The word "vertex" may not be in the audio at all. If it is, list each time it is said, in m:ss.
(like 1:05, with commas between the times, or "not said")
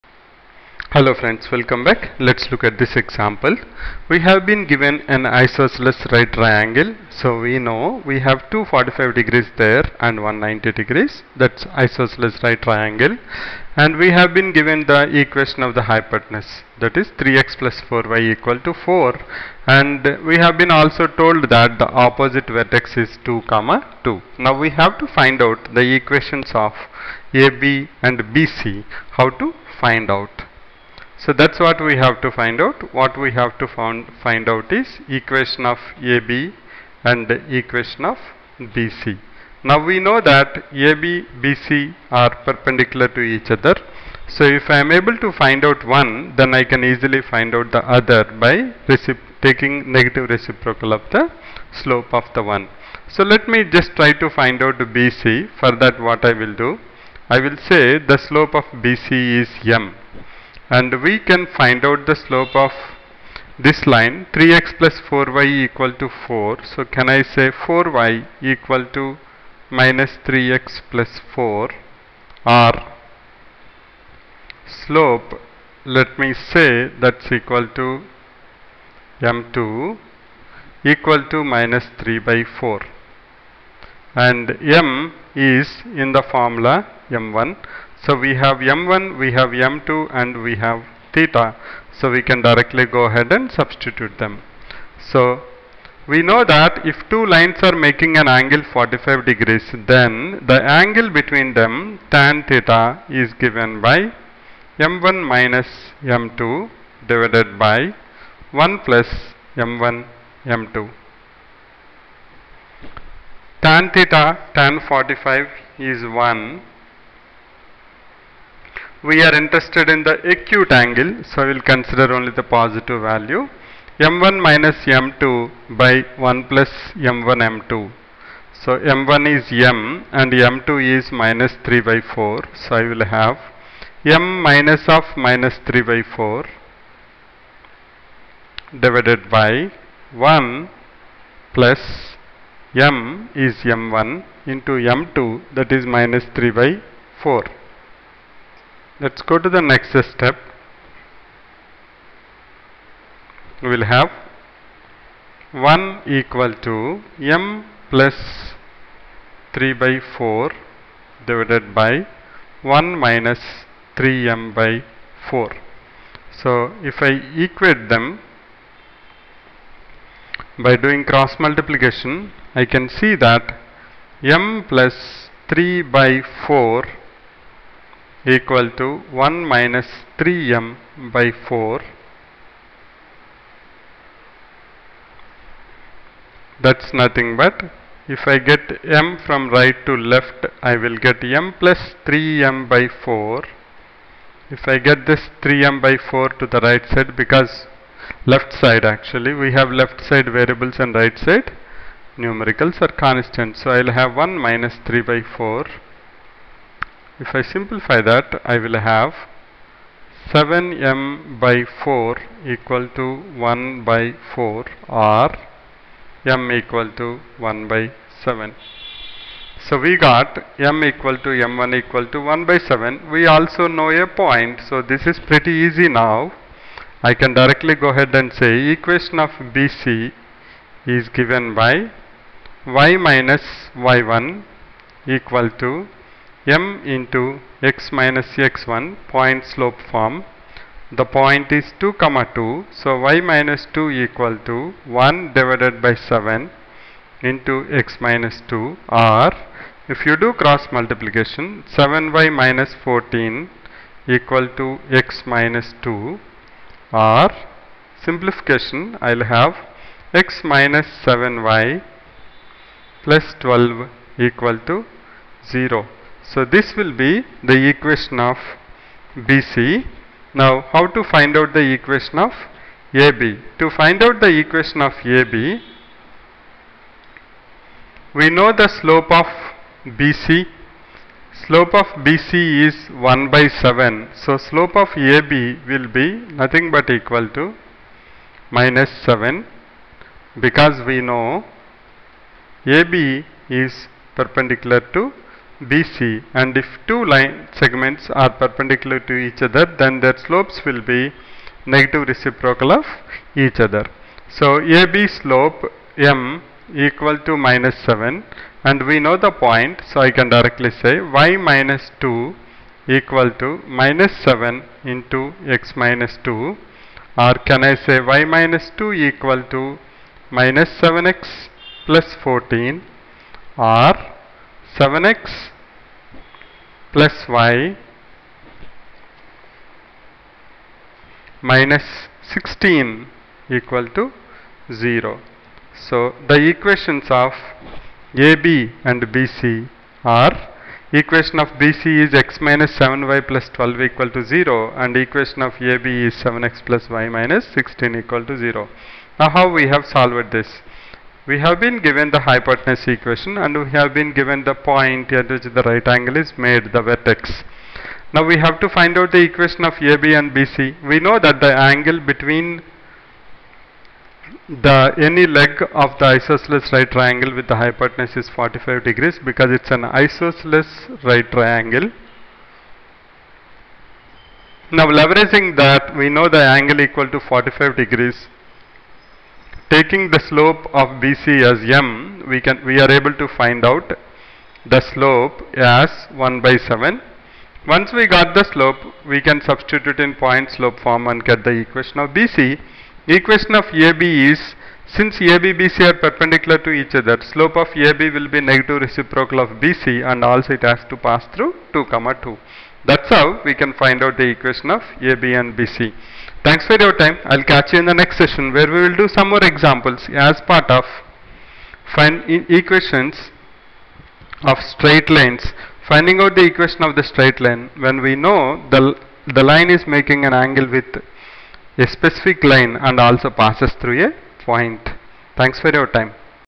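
0:22, 5:56.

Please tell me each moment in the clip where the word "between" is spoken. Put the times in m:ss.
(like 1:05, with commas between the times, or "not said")
1:41, 6:01.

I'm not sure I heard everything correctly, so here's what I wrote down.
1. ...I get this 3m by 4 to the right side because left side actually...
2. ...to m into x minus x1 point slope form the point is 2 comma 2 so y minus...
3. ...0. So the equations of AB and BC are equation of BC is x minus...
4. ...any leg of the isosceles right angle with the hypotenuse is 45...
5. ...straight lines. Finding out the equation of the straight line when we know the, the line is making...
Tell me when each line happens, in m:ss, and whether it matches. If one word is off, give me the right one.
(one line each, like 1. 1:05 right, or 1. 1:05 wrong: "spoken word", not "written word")
1. 3:14 right
2. 3:55 right
3. 5:34 right
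4. 6:04 wrong: "triangle", not "angle"
5. 6:54 right.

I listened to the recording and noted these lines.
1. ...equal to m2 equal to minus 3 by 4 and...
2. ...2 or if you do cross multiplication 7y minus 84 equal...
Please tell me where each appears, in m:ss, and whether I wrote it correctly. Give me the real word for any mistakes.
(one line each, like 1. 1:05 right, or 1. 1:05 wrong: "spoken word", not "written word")
1. 1:17 right
2. 4:08 wrong: "14", not "84".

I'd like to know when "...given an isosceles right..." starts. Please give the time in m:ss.
0:04.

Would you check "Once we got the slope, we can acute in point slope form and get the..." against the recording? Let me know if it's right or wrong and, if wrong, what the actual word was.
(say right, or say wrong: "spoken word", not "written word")
wrong: "substitute", not "acute".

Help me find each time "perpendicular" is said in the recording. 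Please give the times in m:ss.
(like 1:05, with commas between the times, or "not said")
0:42, 4:54, 4:58, 6:35.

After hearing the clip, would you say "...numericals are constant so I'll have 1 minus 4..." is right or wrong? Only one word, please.
wrong.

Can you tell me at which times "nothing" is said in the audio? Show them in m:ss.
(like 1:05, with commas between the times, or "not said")
3:06, 4:46.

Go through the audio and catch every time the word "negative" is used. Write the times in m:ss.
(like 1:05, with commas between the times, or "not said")
0:49, 5:01, 6:38.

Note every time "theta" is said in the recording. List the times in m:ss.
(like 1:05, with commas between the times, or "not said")
1:31, 1:42, 1:53.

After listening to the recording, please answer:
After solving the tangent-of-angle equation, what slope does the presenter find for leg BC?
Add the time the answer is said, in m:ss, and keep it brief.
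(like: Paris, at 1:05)
1/7, at 3:36.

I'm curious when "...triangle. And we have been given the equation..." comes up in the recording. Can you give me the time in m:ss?
0:12.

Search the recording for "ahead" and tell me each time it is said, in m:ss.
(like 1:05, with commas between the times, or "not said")
1:33, 3:47.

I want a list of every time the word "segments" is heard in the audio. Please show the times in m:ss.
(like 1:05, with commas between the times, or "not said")
4:57.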